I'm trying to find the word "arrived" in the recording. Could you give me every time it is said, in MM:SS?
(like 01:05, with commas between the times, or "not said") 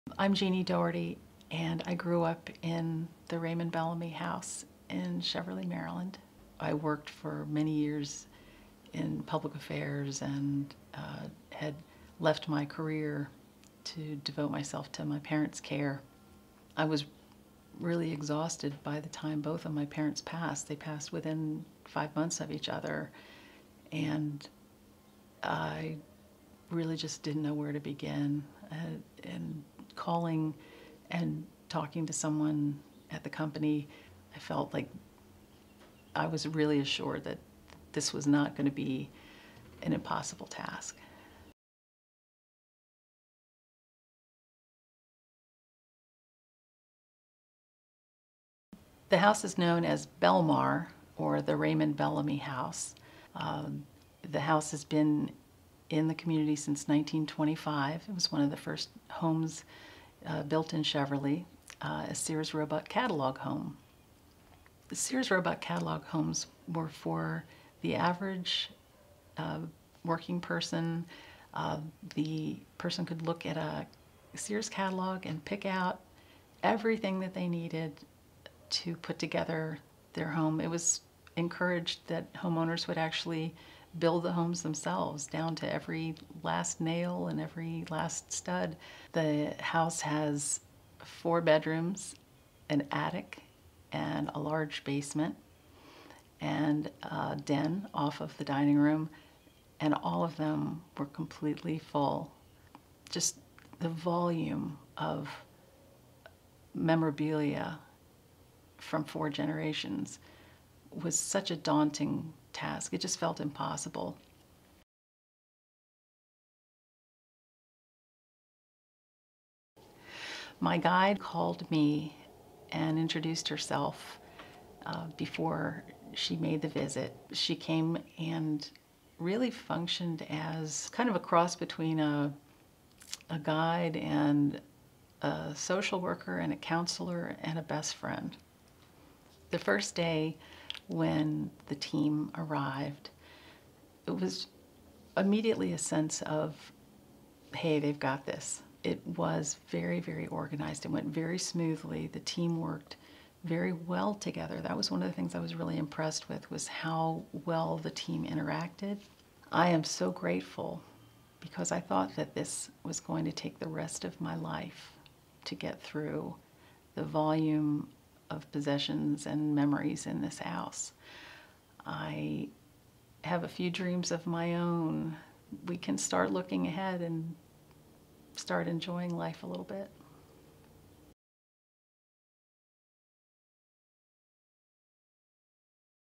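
02:22.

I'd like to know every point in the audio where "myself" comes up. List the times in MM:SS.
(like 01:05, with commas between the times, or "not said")
00:14.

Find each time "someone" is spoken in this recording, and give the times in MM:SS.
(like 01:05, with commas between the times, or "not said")
00:32.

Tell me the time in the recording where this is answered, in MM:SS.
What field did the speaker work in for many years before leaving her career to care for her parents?
00:09.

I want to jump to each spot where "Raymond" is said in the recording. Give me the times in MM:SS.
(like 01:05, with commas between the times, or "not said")
00:03, 00:51.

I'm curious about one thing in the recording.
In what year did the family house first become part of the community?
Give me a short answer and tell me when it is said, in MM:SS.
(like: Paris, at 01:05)
1925, at 00:56.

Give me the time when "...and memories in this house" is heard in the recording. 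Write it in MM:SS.
02:49.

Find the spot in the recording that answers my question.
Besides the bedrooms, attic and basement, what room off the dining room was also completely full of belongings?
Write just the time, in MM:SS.
01:37.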